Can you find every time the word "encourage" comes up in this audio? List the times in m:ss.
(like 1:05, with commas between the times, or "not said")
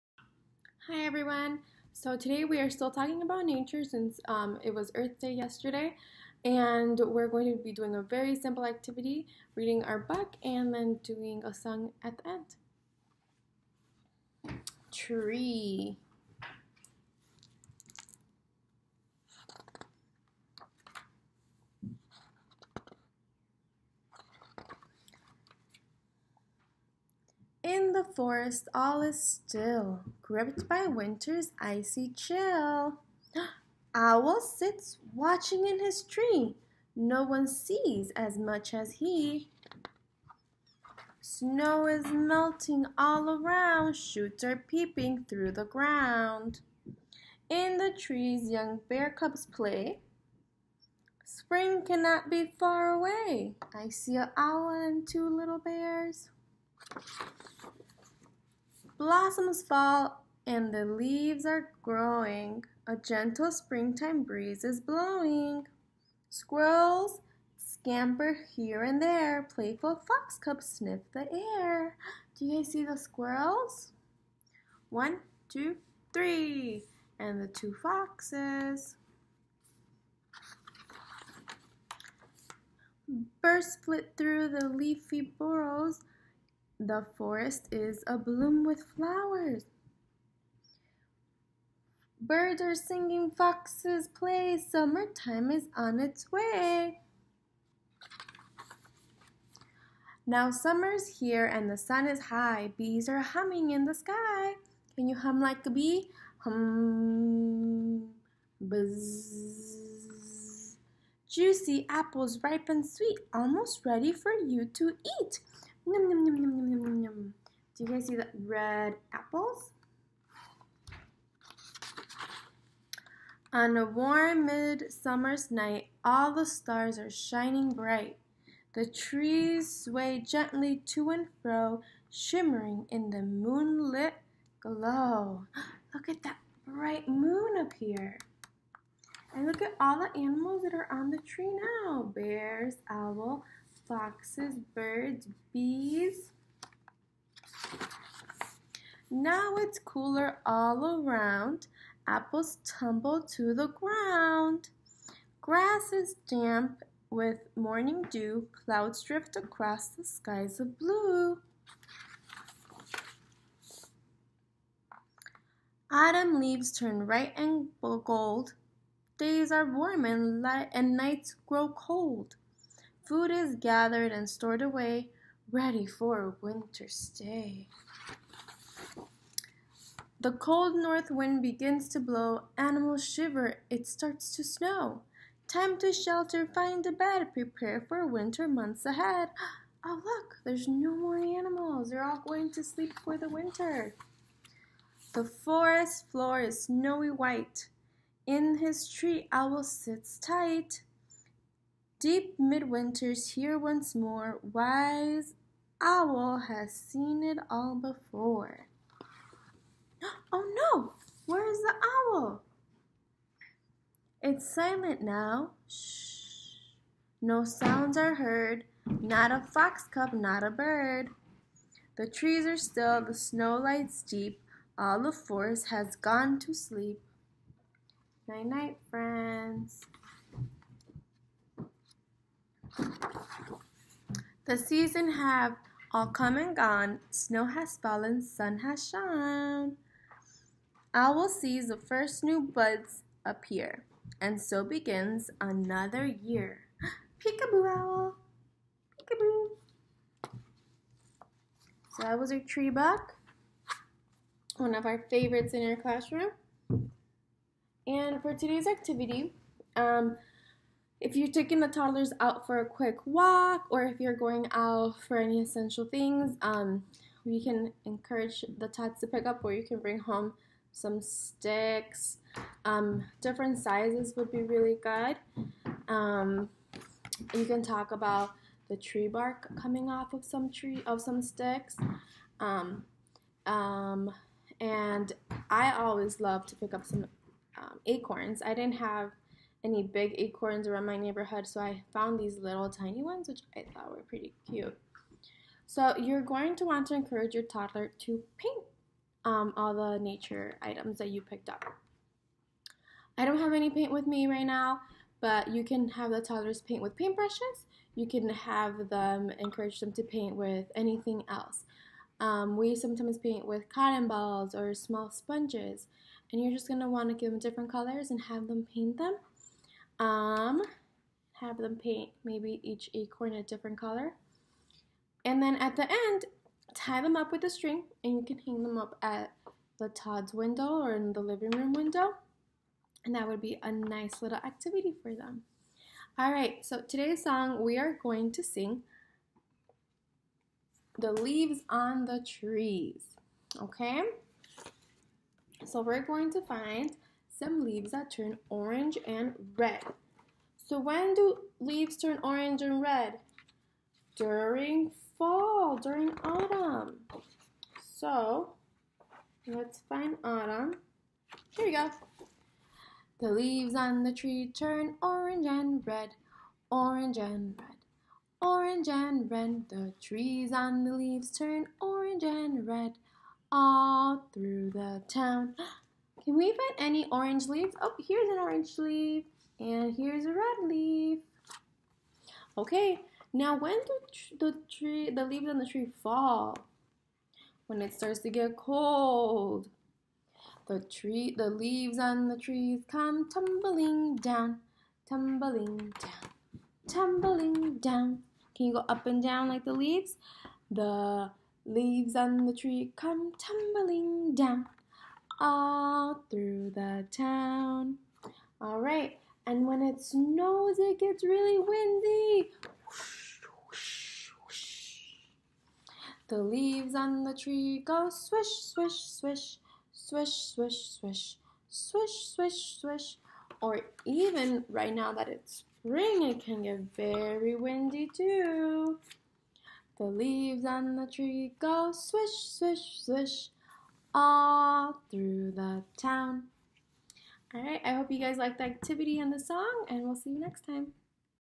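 4:27, 4:56, 5:09.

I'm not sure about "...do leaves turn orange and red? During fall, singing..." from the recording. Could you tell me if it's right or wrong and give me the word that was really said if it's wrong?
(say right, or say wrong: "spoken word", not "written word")
wrong: "during", not "singing".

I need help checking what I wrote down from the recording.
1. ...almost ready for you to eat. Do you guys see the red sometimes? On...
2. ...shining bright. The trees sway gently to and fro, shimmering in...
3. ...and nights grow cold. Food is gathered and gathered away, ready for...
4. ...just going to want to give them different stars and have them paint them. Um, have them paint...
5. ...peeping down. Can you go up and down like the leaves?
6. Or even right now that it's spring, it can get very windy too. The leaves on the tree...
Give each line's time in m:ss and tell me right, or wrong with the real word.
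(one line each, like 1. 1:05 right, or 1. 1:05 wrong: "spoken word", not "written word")
1. 1:53 wrong: "apples", not "sometimes"
2. 2:07 right
3. 2:50 wrong: "stored", not "gathered"
4. 5:16 wrong: "colors", not "stars"
5. 6:36 wrong: "tumbling", not "peeping"
6. 7:03 right.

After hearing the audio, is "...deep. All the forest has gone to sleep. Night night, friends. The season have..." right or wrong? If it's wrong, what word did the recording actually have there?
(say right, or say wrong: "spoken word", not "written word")
right.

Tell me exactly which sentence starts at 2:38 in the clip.
Clouds drift across the skies of blue.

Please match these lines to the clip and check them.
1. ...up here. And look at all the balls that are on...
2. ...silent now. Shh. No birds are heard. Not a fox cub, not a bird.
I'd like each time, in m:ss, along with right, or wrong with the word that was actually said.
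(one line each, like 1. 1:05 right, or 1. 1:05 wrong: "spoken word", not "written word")
1. 2:17 wrong: "animals", not "balls"
2. 3:34 wrong: "sounds", not "birds".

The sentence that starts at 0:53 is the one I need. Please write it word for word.
I see an owl and two little bears.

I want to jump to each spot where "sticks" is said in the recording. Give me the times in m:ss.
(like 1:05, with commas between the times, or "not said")
4:31, 4:41.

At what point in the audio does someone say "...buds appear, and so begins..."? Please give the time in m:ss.
4:02.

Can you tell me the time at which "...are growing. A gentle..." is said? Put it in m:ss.
1:01.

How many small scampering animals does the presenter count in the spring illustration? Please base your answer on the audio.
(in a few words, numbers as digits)
3.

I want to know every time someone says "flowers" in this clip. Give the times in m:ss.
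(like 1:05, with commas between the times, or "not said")
1:28.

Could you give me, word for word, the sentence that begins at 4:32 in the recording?
Um, different sizes would be really good.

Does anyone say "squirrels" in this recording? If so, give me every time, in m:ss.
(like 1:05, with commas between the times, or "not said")
1:06, 1:12.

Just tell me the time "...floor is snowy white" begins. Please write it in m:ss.
3:16.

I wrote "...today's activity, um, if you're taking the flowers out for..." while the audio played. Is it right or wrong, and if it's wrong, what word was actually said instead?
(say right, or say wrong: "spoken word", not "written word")
wrong: "toddlers", not "flowers".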